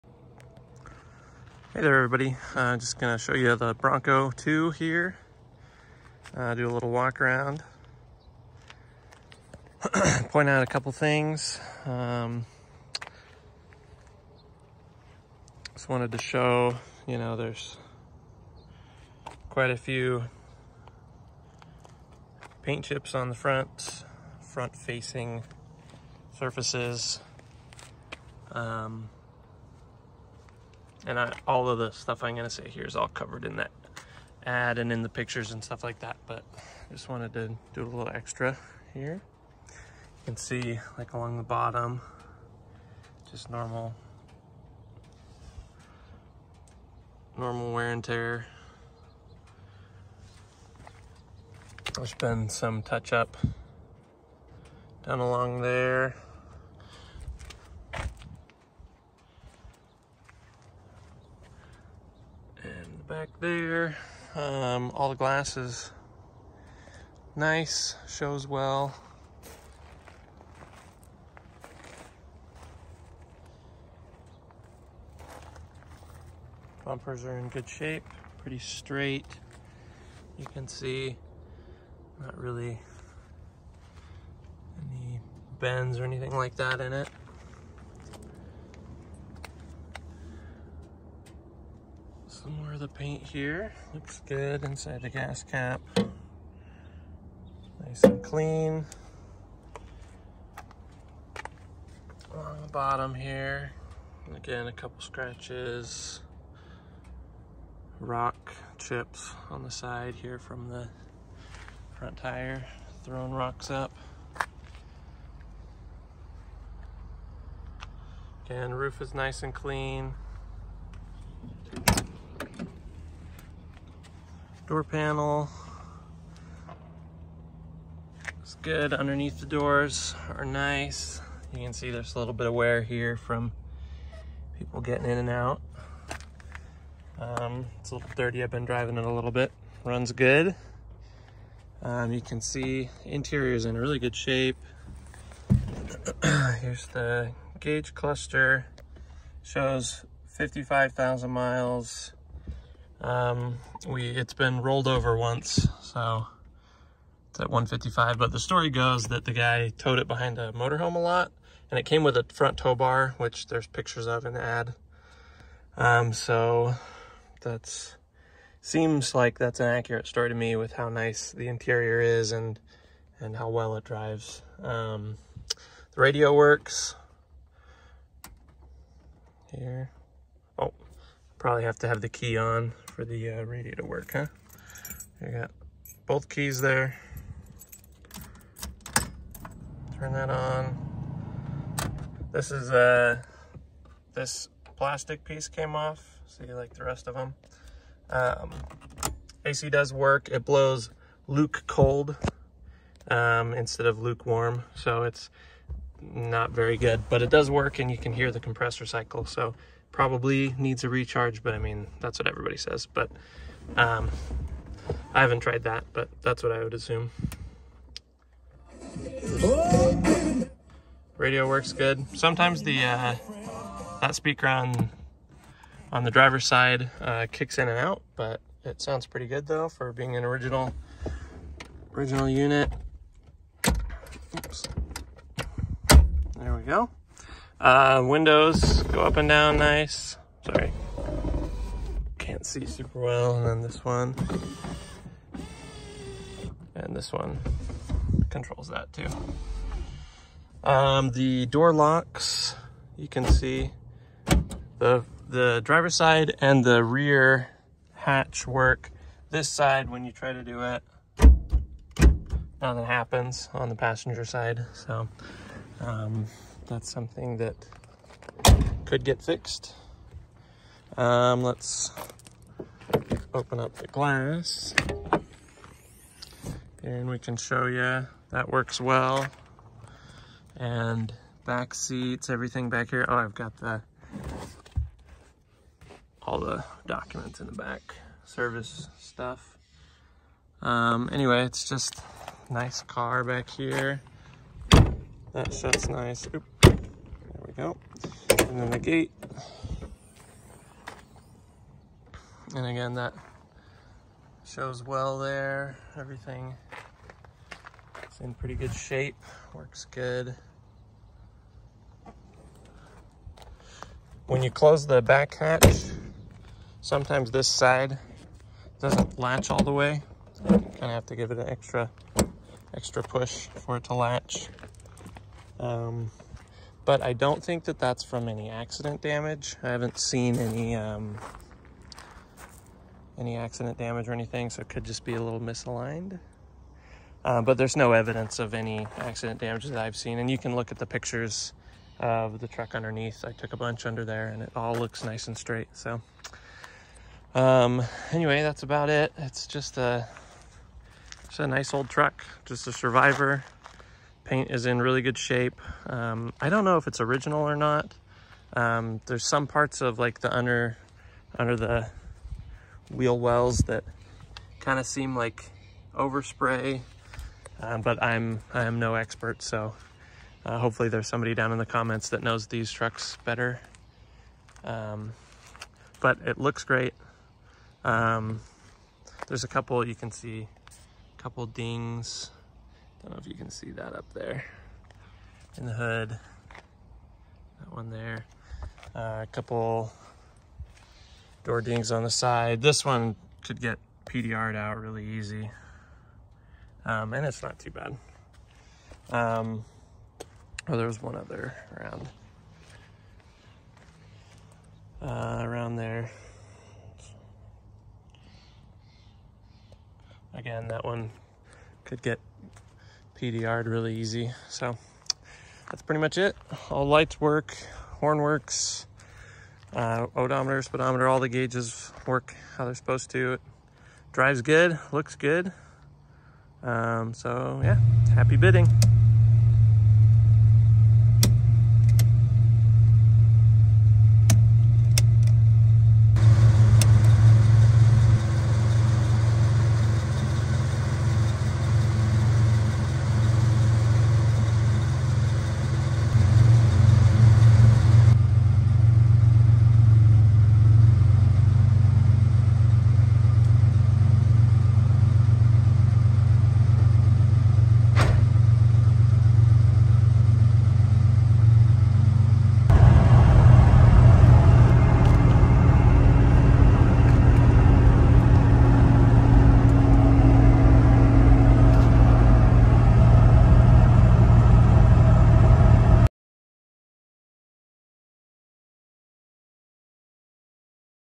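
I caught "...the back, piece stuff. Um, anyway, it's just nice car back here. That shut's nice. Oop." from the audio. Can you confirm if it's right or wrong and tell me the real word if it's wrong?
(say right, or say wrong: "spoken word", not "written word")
wrong: "service", not "piece".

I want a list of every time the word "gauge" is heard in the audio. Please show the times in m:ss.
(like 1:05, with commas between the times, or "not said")
2:27, 7:01.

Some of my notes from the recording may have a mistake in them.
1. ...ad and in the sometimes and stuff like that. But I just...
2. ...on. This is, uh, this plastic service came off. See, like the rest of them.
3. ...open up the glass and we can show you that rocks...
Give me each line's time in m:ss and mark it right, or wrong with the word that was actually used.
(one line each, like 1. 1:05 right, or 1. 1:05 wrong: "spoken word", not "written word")
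1. 0:34 wrong: "pictures", not "sometimes"
2. 3:10 wrong: "piece", not "service"
3. 4:33 wrong: "works", not "rocks".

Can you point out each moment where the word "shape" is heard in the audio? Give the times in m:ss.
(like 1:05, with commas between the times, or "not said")
1:17, 2:24, 5:08, 5:55.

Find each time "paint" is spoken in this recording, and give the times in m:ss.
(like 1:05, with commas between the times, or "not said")
0:22, 1:32, 5:54.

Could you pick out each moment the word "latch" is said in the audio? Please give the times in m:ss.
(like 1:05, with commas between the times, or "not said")
5:19, 5:23.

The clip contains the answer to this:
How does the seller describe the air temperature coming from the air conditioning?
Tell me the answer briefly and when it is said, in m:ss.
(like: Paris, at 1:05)
Luke cold, at 3:21.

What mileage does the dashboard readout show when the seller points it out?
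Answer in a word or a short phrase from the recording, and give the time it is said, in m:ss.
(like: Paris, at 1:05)
55,000 miles, at 2:30.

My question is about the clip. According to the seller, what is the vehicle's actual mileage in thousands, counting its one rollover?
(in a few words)
155.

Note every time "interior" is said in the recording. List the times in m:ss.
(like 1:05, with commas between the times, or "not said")
2:23, 2:51.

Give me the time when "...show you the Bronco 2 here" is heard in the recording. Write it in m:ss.
0:03.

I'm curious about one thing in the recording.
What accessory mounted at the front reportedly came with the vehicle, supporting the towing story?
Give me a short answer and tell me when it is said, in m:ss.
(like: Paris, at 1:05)
Front tow bar, at 2:42.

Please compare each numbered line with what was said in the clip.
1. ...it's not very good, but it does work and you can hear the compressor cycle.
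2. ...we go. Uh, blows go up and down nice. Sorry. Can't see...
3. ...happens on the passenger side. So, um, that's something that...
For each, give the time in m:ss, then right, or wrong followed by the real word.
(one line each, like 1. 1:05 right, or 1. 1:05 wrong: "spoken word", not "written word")
1. 3:25 right
2. 3:56 wrong: "windows", not "blows"
3. 4:22 right.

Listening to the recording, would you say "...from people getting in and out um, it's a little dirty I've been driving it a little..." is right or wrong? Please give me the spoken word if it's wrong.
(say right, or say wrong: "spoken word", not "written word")
right.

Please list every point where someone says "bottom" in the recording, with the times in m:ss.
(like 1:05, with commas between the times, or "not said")
0:41, 1:42.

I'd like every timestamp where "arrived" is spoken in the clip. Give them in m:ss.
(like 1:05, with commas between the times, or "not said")
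not said.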